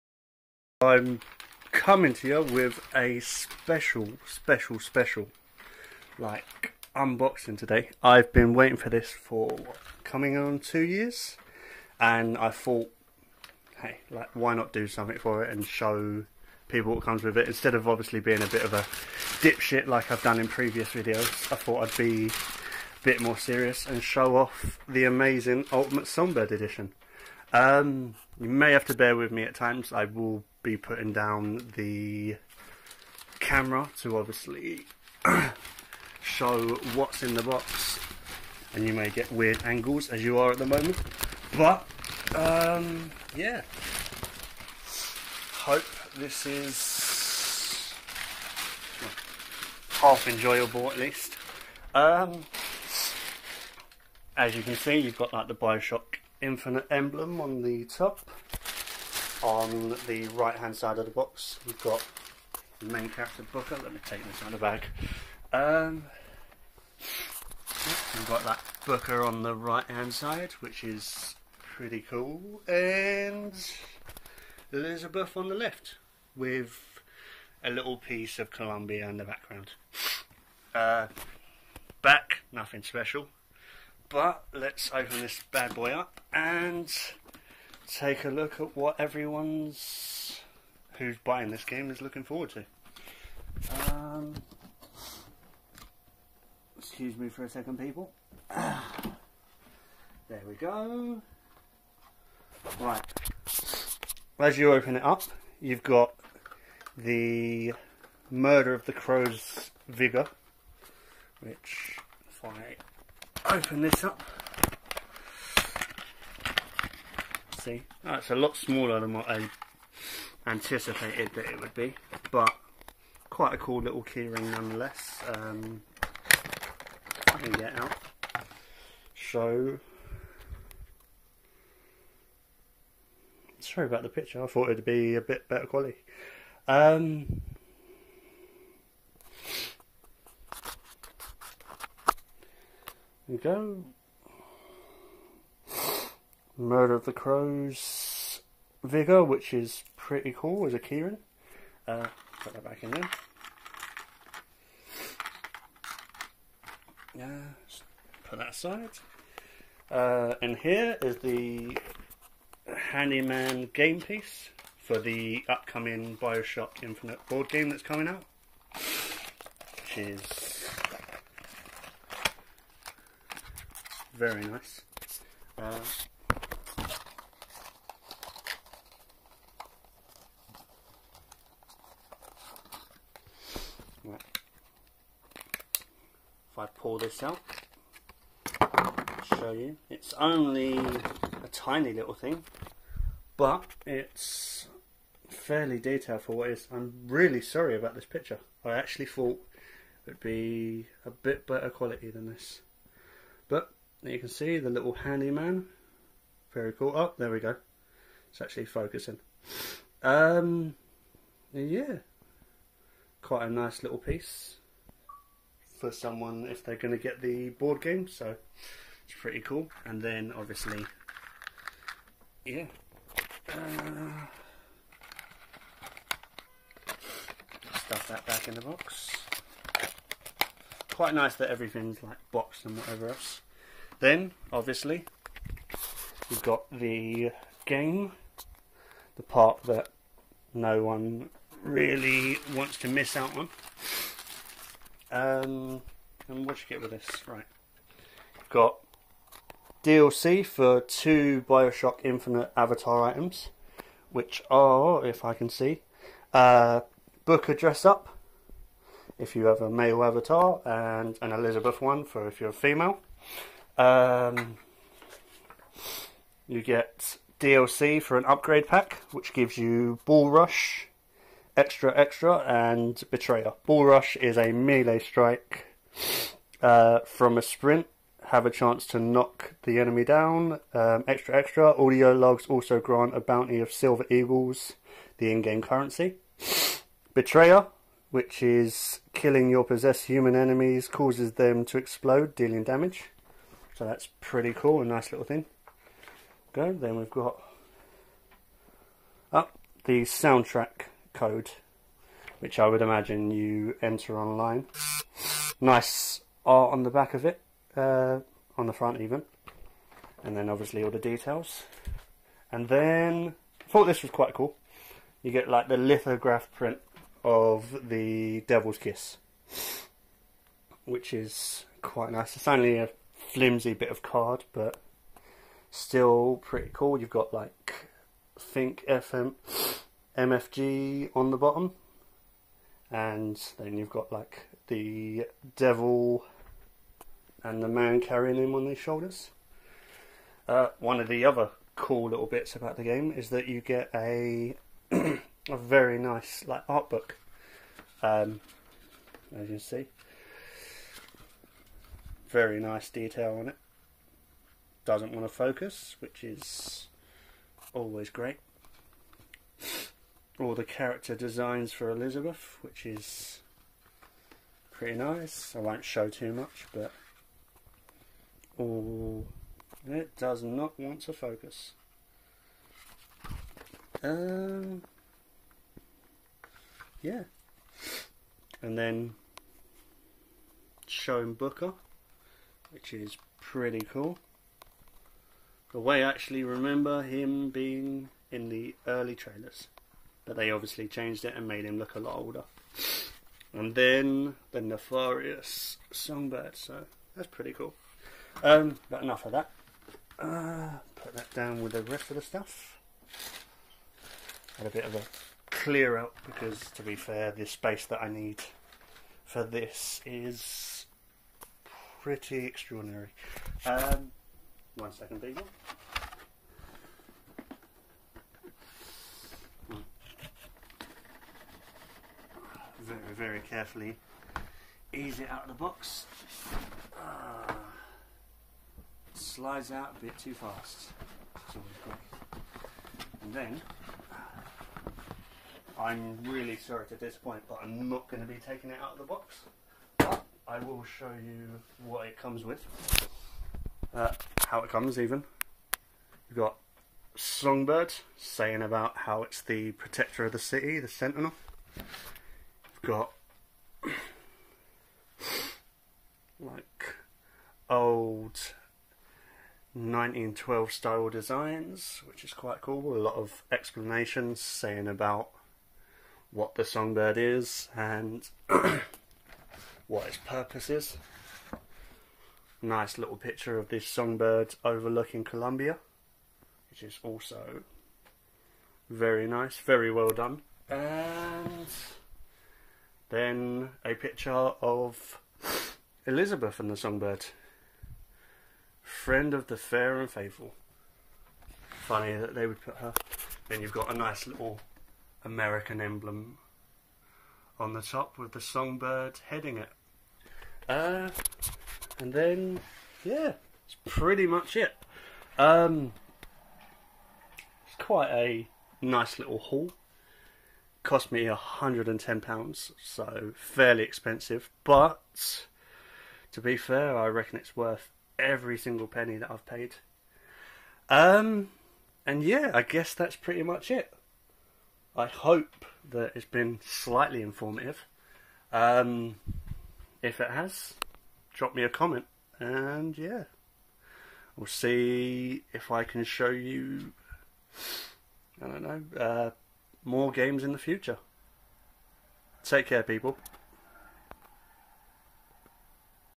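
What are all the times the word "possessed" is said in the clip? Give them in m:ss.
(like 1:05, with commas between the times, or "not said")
4:49.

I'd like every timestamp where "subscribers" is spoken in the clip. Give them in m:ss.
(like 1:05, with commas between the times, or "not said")
not said.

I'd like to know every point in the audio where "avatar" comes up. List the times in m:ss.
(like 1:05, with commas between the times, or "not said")
4:12, 4:20.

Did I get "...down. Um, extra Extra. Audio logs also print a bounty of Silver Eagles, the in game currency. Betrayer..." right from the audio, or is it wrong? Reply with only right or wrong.
wrong.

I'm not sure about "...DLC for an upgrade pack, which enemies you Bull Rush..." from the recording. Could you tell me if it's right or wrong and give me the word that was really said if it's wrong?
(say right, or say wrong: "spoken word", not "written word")
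wrong: "gives", not "enemies".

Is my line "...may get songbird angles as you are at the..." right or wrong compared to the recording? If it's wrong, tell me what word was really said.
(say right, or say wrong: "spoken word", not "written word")
wrong: "weird", not "songbird".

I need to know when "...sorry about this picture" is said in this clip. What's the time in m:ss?
3:17.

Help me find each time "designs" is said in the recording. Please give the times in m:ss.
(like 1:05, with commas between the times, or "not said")
6:01, 7:41.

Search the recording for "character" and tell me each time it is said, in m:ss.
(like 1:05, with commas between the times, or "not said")
1:03, 6:00.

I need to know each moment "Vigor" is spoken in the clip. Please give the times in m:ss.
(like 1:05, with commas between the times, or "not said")
1:49, 2:28.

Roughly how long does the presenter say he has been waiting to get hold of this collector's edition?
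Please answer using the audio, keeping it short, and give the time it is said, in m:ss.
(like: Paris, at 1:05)
2 years, at 0:10.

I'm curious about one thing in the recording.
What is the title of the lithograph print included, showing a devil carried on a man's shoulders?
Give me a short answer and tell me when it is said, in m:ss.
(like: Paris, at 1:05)
Devil's Kiss, at 5:18.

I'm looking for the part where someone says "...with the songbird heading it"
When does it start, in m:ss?
8:18.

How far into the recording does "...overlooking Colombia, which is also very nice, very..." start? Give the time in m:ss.
7:54.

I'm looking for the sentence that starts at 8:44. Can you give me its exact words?
I hope that it's been slightly informative.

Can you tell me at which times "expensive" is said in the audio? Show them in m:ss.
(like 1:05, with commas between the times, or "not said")
8:33.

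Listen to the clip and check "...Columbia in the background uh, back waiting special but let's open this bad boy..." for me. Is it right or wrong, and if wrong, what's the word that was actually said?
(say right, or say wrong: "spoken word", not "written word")
wrong: "nothing", not "waiting".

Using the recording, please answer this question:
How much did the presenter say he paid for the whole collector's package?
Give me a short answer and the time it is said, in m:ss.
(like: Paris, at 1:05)
£110, at 8:31.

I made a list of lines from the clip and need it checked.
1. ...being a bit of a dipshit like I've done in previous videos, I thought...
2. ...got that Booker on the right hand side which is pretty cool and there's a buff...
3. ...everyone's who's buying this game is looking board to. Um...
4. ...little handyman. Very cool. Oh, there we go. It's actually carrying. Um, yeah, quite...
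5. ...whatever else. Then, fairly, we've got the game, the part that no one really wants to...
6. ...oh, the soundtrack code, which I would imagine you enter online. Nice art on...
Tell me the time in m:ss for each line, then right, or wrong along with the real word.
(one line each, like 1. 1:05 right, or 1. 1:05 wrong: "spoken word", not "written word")
1. 0:18 right
2. 1:08 right
3. 1:28 wrong: "forward", not "board"
4. 3:24 wrong: "focusing", not "carrying"
5. 3:52 wrong: "obviously", not "fairly"
6. 4:59 right.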